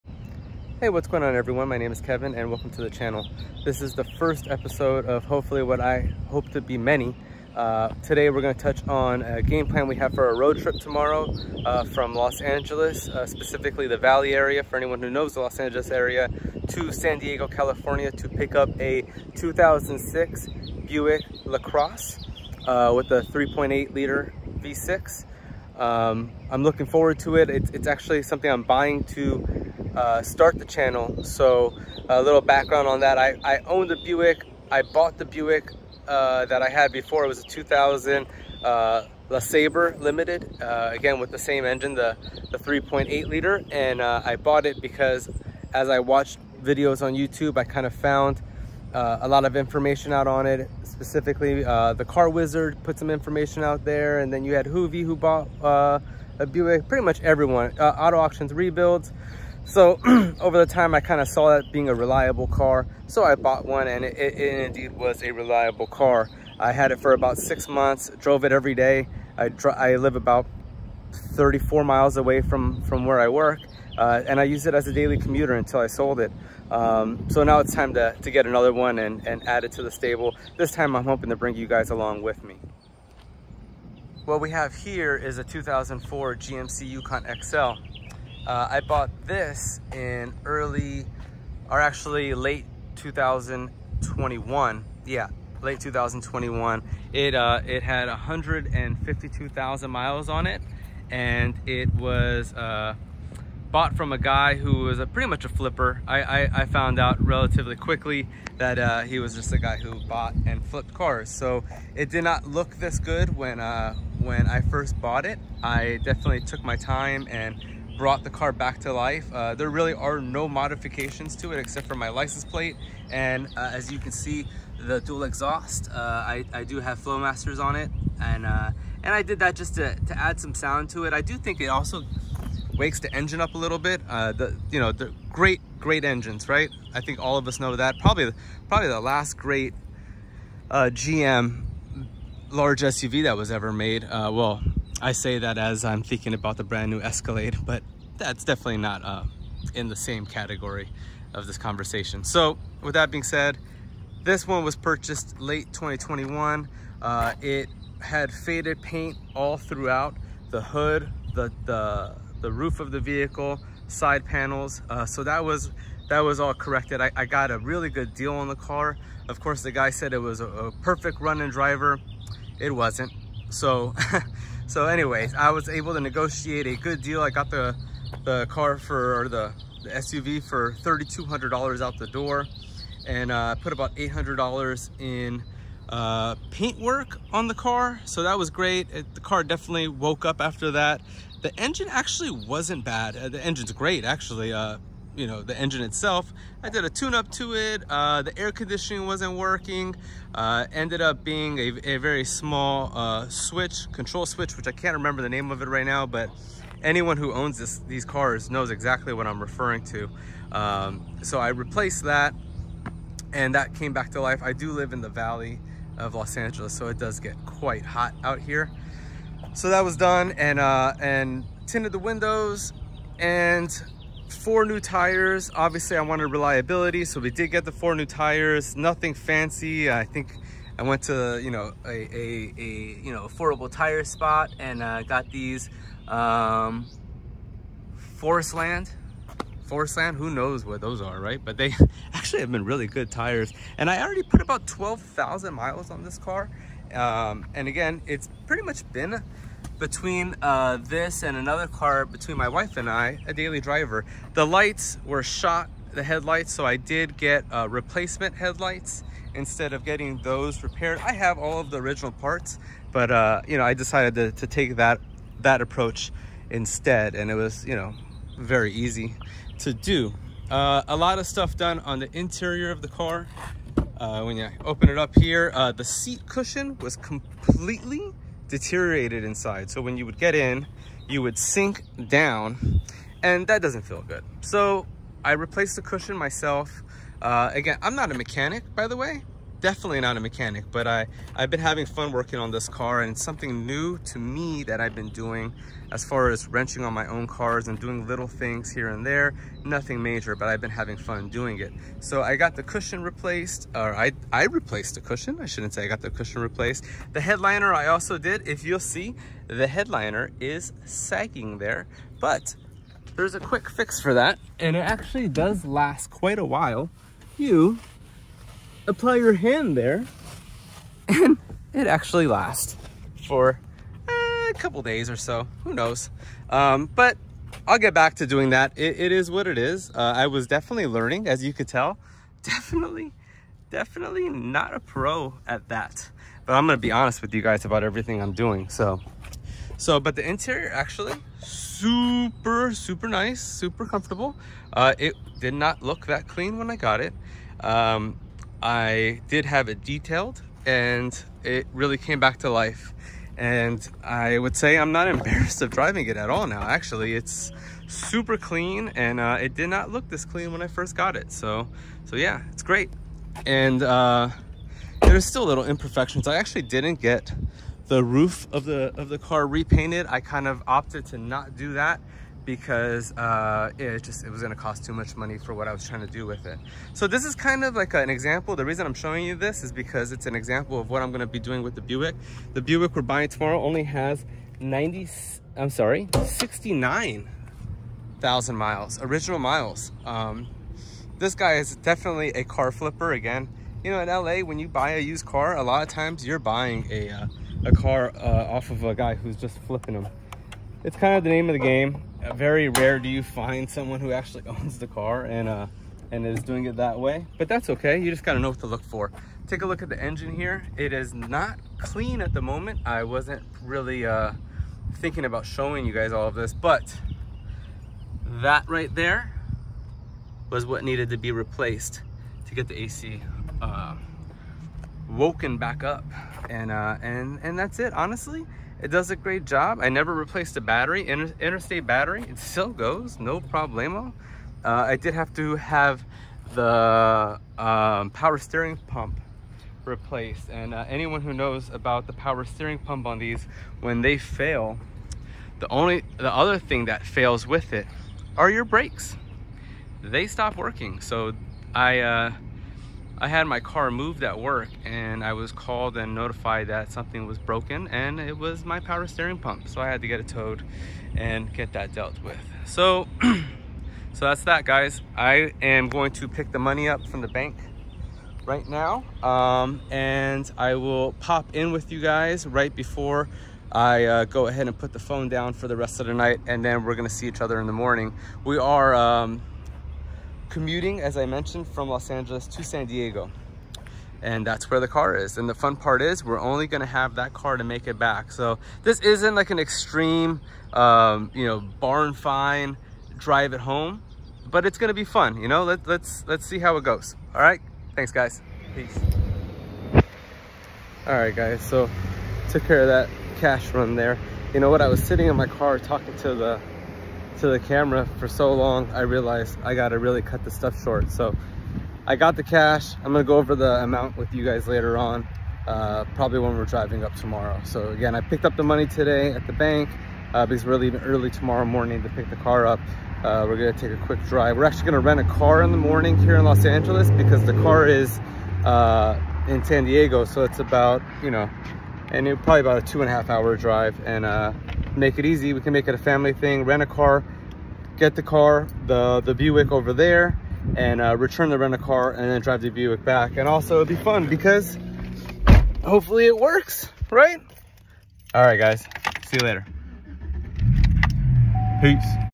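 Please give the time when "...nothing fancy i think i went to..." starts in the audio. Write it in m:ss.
3:48.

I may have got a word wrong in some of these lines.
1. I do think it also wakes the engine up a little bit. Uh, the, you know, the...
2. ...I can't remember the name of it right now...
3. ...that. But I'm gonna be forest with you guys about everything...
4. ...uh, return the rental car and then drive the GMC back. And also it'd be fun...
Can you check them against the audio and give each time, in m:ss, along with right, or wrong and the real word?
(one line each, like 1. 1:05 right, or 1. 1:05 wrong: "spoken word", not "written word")
1. 2:11 right
2. 3:24 right
3. 5:35 wrong: "honest", not "forest"
4. 9:01 wrong: "Buick", not "GMC".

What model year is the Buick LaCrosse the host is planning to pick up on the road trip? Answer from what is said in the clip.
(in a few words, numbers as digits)
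2006.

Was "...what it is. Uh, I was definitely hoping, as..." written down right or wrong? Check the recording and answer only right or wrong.
wrong.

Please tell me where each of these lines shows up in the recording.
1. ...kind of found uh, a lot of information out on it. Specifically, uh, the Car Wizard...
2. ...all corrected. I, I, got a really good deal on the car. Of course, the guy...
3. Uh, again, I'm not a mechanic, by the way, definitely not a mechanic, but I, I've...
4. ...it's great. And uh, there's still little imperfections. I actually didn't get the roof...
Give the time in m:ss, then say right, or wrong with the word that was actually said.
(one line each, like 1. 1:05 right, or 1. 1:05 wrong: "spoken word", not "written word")
1. 0:47 right
2. 2:46 right
3. 4:47 right
4. 6:02 right.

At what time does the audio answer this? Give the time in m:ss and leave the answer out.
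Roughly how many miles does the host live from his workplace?
1:11.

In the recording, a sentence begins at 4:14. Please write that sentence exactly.
The lights were shot, the headlights, so I did get uh, replacement headlights instead of getting those repaired.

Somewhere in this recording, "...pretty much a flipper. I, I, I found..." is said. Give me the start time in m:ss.
1:45.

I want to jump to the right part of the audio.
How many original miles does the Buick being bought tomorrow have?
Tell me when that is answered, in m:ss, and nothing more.
6:26.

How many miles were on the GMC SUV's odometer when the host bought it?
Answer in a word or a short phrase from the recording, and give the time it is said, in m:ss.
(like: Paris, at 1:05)
152,000, at 1:38.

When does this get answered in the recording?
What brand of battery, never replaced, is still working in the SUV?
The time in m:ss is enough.
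7:11.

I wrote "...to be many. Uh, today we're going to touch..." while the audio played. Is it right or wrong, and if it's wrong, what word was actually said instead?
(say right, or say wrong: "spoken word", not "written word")
right.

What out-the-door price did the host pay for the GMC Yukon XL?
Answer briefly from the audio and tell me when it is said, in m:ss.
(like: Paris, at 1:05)
$3,200, at 3:00.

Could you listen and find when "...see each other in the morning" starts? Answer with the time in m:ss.
7:57.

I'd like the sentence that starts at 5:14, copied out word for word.
And it actually does last quite a while.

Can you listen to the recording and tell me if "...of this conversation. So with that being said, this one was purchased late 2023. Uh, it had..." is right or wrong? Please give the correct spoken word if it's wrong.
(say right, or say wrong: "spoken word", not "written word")
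wrong: "2021", not "2023".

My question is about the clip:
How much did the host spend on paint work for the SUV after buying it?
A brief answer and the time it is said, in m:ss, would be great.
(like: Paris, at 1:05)
$800, at 3:03.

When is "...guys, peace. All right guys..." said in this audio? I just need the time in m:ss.
8:18.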